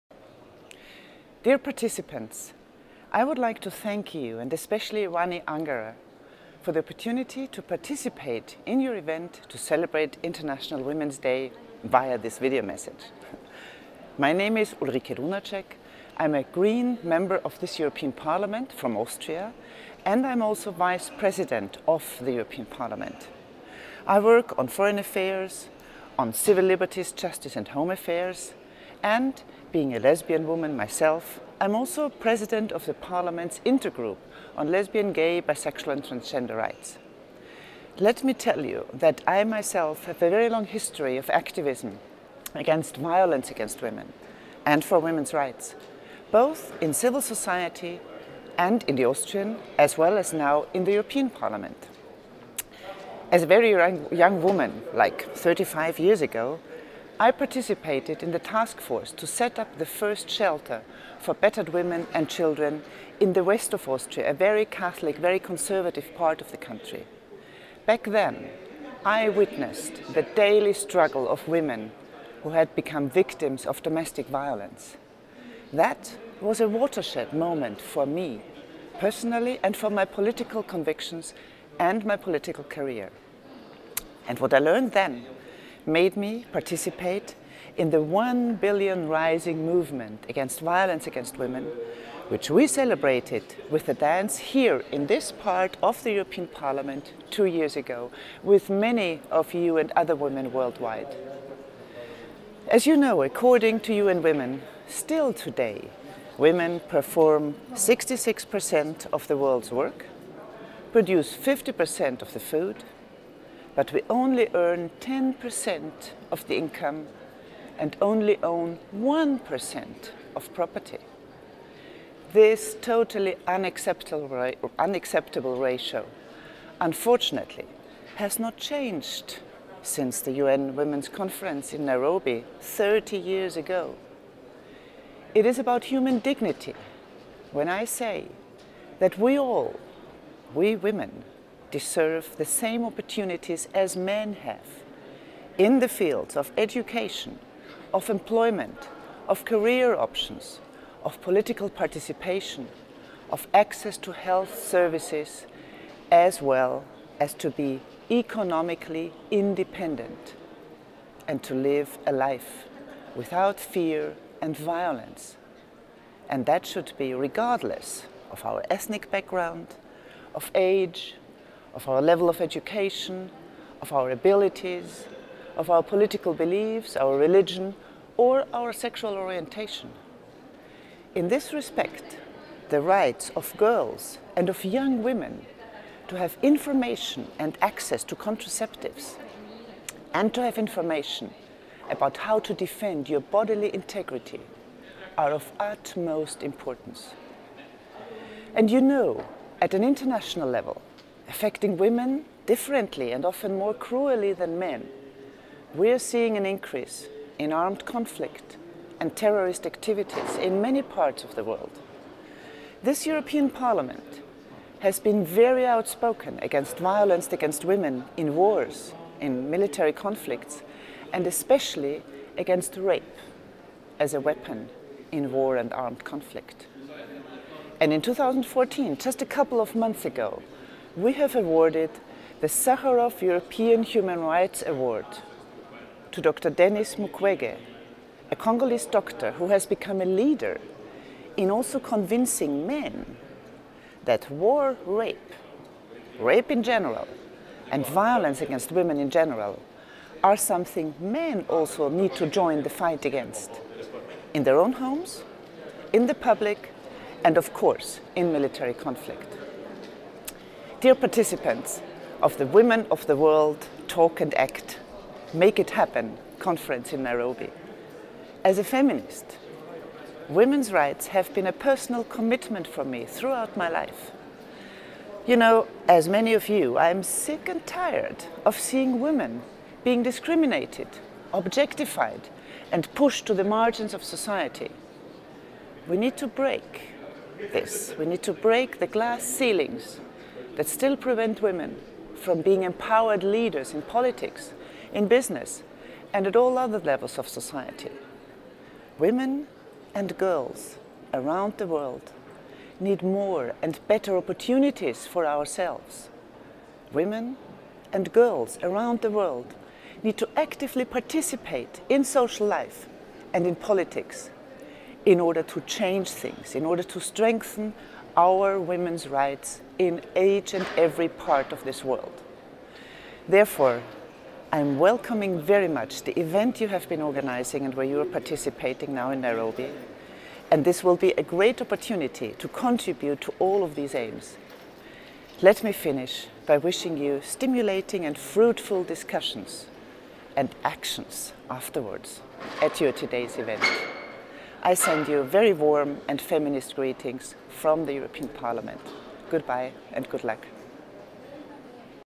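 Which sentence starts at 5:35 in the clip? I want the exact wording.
Let me finish by wishing you stimulating and fruitful discussions and actions afterwards at your today's event.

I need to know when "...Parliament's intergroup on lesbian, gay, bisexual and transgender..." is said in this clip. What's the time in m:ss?
0:32.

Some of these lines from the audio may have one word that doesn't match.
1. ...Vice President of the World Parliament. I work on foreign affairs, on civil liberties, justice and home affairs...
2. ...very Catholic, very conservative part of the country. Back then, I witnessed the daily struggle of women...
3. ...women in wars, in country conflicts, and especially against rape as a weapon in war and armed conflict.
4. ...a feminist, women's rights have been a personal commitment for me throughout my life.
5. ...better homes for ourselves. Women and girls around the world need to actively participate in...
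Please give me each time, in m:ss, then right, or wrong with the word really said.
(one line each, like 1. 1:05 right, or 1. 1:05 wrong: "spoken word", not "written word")
1. 0:20 wrong: "European", not "World"
2. 1:04 right
3. 3:37 wrong: "military", not "country"
4. 4:28 right
5. 5:03 wrong: "opportunities", not "homes".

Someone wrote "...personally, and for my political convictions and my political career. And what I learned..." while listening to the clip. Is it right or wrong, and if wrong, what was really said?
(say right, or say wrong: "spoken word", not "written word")
right.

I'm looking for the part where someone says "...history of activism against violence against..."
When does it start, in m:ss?
0:40.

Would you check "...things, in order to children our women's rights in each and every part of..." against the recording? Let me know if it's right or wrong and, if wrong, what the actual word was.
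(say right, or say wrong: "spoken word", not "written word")
wrong: "strengthen", not "children".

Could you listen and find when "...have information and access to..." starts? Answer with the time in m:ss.
3:06.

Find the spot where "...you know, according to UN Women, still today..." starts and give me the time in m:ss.
1:42.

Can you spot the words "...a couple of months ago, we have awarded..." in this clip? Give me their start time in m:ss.
3:49.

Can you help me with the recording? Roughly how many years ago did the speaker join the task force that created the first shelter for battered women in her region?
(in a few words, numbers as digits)
35 years.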